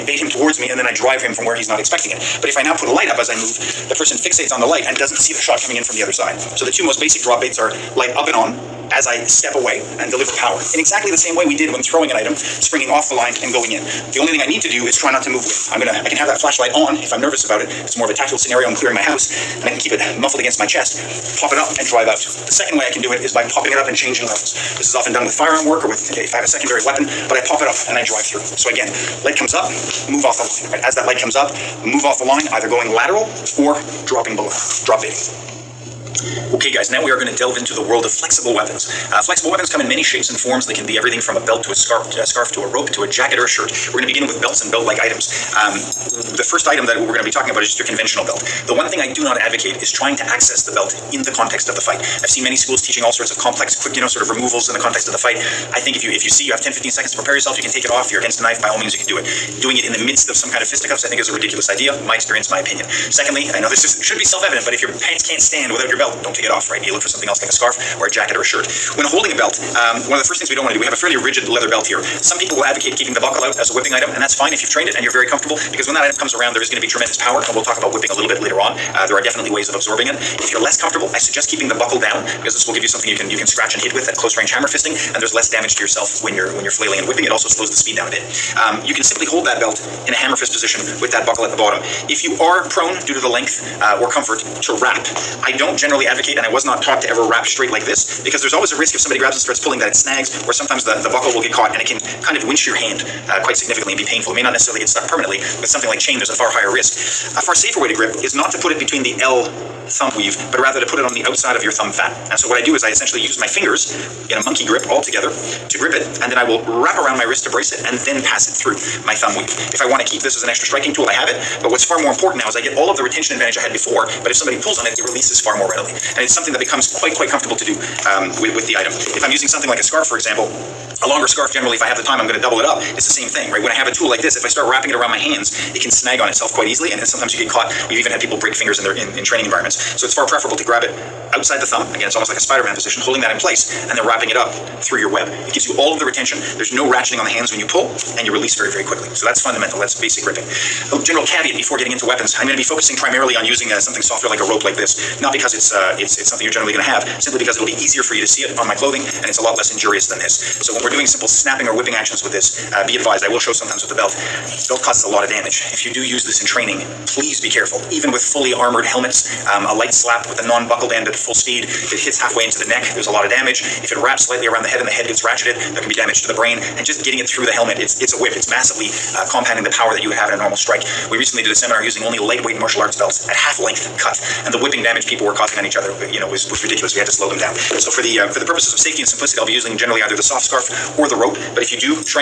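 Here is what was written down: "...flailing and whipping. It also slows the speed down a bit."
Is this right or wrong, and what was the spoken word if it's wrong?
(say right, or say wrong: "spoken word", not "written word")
right.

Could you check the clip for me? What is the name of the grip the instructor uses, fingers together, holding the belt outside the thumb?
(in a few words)
monkey grip.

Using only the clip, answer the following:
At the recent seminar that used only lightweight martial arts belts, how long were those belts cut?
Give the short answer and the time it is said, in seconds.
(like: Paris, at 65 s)
half length, at 183 s.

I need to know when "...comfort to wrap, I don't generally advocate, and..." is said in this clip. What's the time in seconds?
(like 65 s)
94 s.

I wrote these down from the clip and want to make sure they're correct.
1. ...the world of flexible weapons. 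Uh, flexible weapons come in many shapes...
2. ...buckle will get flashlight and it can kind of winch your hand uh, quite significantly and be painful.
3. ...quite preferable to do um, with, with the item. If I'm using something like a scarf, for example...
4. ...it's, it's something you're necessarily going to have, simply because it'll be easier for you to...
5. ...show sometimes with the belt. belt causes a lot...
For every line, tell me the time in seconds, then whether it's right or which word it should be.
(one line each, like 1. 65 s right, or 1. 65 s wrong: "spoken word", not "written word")
1. 37 s right
2. 101 s wrong: "caught", not "flashlight"
3. 127 s wrong: "comfortable", not "preferable"
4. 155 s wrong: "generally", not "necessarily"
5. 163 s right.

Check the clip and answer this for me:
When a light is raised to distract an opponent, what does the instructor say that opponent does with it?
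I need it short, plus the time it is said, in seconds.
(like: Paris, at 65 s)
fixates on the light, at 4 s.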